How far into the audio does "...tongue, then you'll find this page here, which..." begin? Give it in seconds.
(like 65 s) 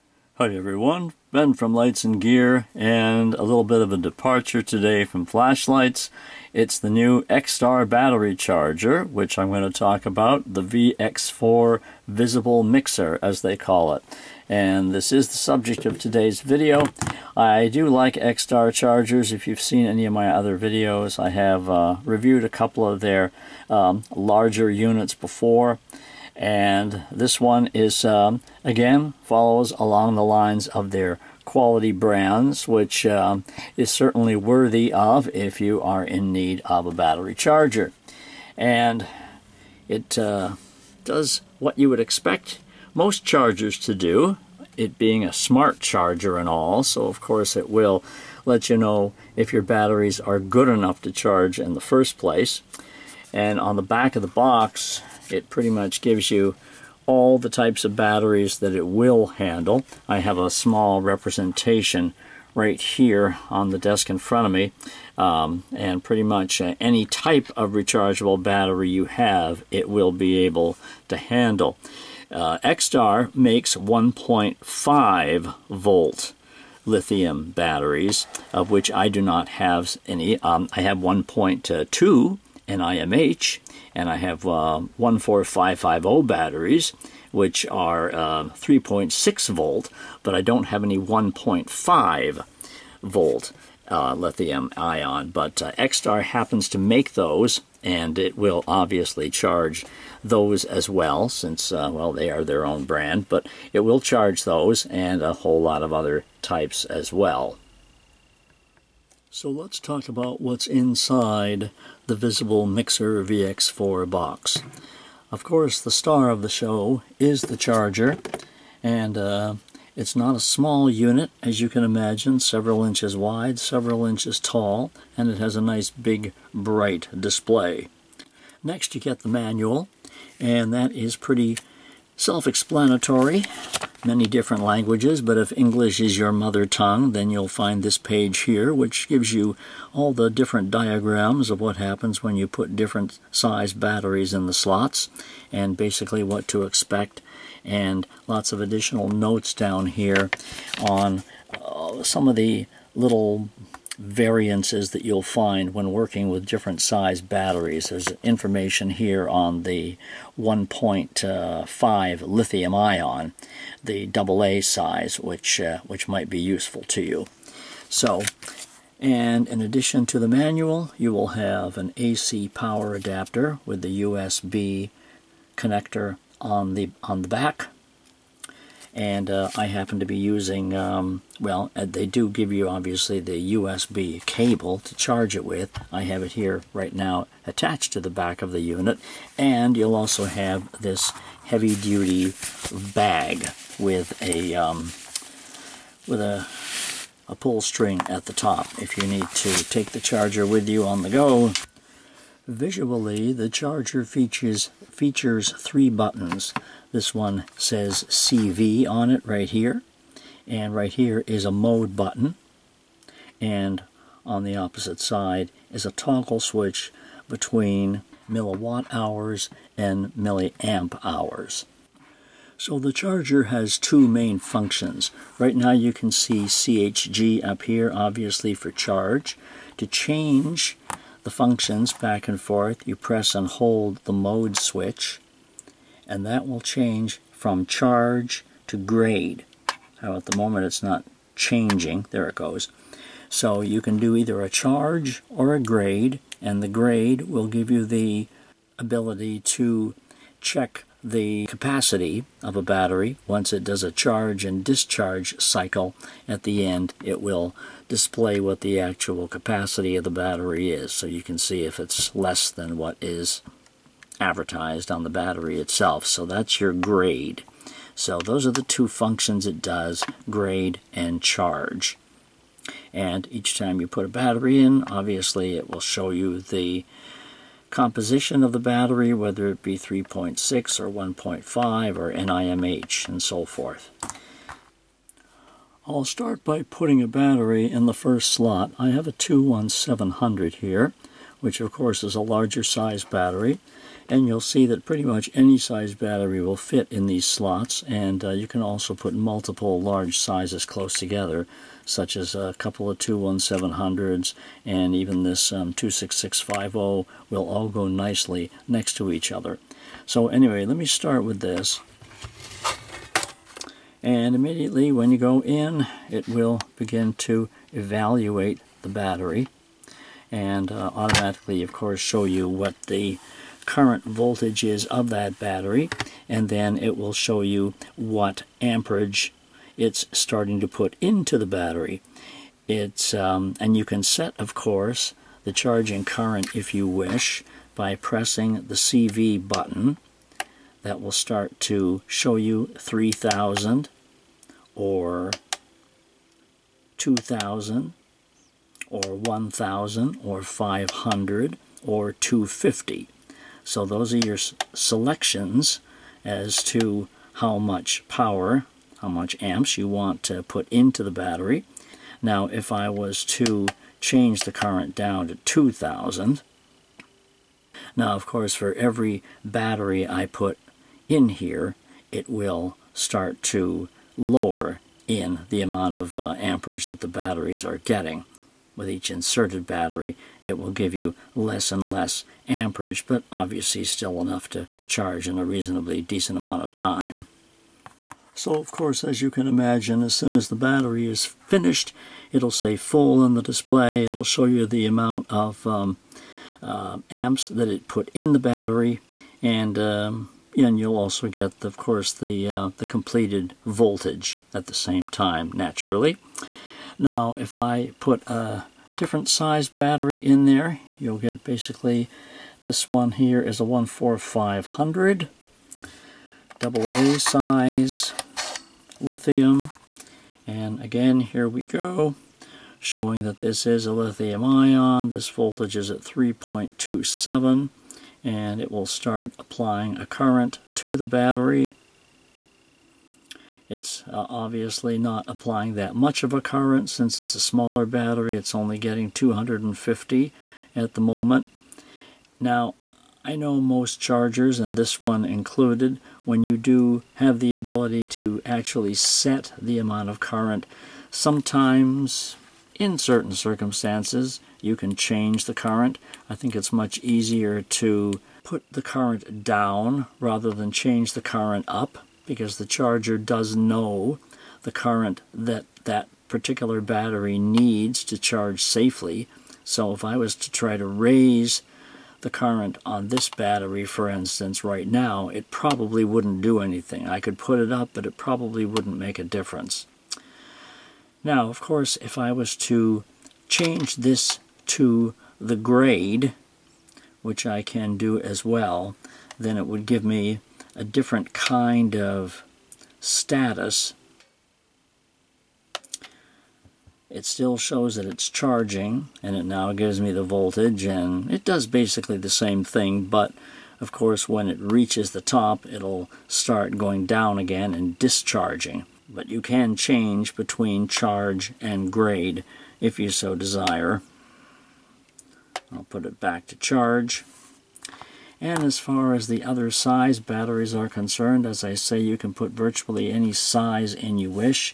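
136 s.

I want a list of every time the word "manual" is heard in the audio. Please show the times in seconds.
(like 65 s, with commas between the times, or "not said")
129 s, 170 s.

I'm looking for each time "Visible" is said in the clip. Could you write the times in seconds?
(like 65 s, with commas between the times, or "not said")
12 s, 112 s.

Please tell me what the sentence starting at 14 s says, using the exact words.
And this is the subject of today's video.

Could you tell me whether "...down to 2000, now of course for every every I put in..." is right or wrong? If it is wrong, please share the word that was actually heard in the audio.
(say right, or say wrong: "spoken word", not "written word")
wrong: "battery", not "every".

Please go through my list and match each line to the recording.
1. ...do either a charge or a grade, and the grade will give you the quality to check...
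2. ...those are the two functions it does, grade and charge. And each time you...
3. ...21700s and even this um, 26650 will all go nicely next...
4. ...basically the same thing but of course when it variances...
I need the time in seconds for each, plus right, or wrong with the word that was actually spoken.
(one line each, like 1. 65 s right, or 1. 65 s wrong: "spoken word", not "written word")
1. 243 s wrong: "ability", not "quality"
2. 268 s right
3. 302 s right
4. 501 s wrong: "reaches", not "variances".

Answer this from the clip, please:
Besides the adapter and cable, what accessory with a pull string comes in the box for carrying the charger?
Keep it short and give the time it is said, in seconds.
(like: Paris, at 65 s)
heavy-duty bag, at 191 s.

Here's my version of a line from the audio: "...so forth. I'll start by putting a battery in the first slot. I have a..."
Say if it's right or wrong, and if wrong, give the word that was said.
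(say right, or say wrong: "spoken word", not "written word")
right.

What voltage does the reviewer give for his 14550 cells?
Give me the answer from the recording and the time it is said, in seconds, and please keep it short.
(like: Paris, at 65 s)
3.6 volt, at 88 s.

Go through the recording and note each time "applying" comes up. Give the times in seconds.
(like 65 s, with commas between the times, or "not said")
429 s, 435 s.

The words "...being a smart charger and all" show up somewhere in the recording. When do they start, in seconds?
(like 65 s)
44 s.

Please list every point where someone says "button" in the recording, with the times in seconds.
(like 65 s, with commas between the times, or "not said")
205 s, 211 s, 339 s.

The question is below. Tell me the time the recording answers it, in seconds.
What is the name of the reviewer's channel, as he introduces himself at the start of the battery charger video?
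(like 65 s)
1 s.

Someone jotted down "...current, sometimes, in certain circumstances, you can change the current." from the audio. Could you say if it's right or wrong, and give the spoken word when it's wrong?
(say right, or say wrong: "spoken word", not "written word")
right.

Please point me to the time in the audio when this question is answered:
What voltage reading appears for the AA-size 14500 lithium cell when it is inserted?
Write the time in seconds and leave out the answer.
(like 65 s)
426 s.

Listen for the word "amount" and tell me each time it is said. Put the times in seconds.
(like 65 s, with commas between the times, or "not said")
375 s, 386 s, 394 s, 449 s.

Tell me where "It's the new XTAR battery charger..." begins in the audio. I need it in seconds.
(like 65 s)
6 s.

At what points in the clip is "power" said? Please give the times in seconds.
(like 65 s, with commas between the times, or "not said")
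172 s, 358 s.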